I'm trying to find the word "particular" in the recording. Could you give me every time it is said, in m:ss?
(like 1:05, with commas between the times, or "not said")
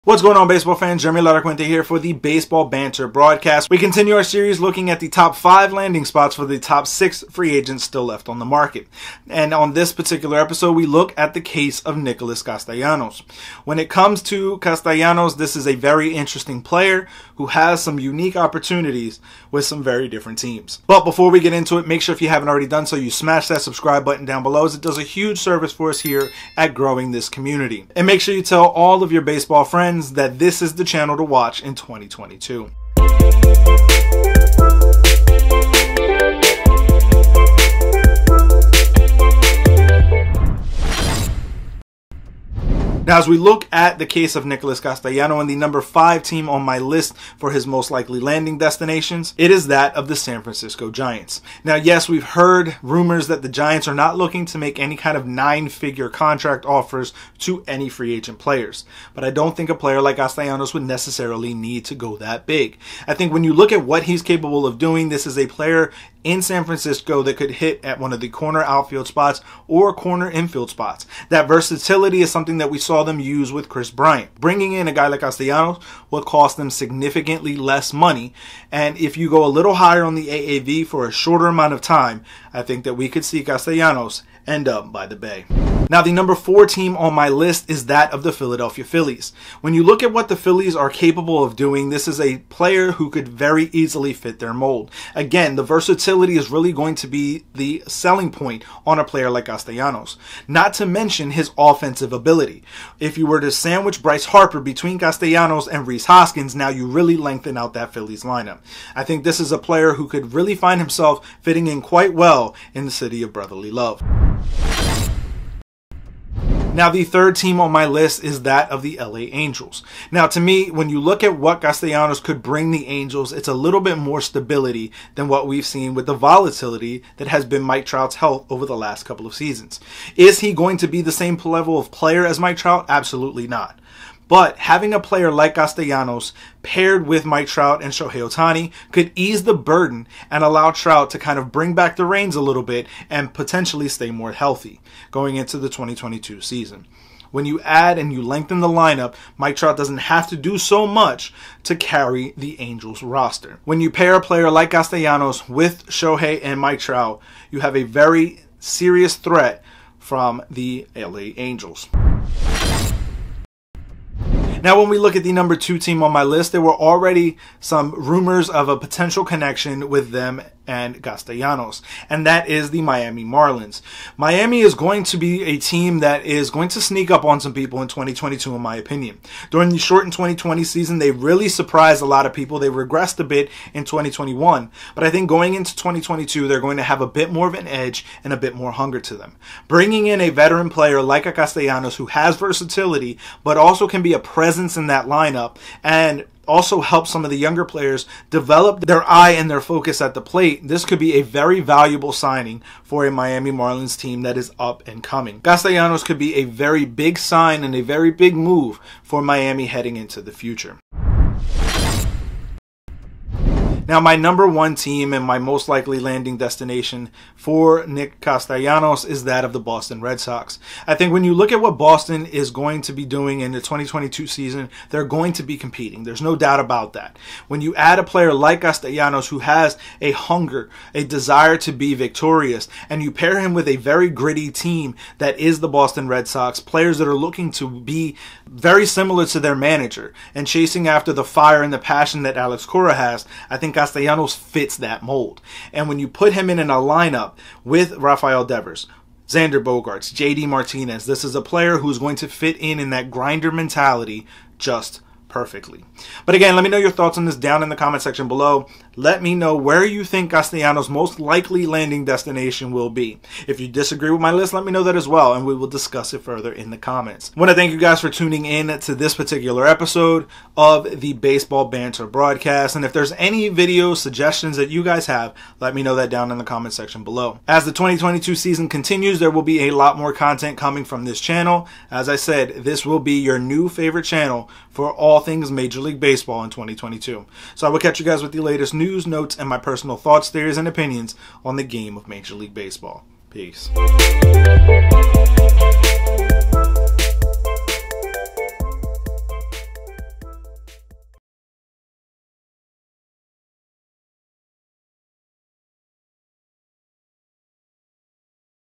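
0:09, 4:29.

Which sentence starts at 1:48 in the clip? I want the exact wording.
I think this is a player who could really find himself fitting in quite well in the city of brotherly love.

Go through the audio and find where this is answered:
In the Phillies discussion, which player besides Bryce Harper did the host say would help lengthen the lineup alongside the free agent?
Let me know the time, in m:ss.
1:45.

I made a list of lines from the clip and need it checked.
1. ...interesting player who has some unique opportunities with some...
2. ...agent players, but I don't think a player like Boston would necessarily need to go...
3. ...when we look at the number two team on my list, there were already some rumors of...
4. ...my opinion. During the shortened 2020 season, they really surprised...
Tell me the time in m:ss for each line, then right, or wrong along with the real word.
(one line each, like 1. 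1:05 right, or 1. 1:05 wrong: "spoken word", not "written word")
1. 0:16 right
2. 0:58 wrong: "Castellanos", not "Boston"
3. 2:44 right
4. 2:58 right.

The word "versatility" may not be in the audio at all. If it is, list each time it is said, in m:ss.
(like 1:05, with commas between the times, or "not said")
1:11, 1:35, 3:12.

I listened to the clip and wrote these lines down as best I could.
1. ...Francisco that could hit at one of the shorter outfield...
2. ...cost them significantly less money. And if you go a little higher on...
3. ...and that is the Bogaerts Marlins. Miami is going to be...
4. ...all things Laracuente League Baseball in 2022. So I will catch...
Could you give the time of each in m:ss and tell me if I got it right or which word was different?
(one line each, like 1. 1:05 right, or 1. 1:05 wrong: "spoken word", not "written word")
1. 1:06 wrong: "corner", not "shorter"
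2. 1:16 right
3. 2:52 wrong: "Miami", not "Bogaerts"
4. 4:44 wrong: "Major", not "Laracuente".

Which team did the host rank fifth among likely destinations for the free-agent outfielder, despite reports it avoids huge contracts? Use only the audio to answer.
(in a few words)
San Francisco Giants.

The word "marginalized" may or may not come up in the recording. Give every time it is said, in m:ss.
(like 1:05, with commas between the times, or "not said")
not said.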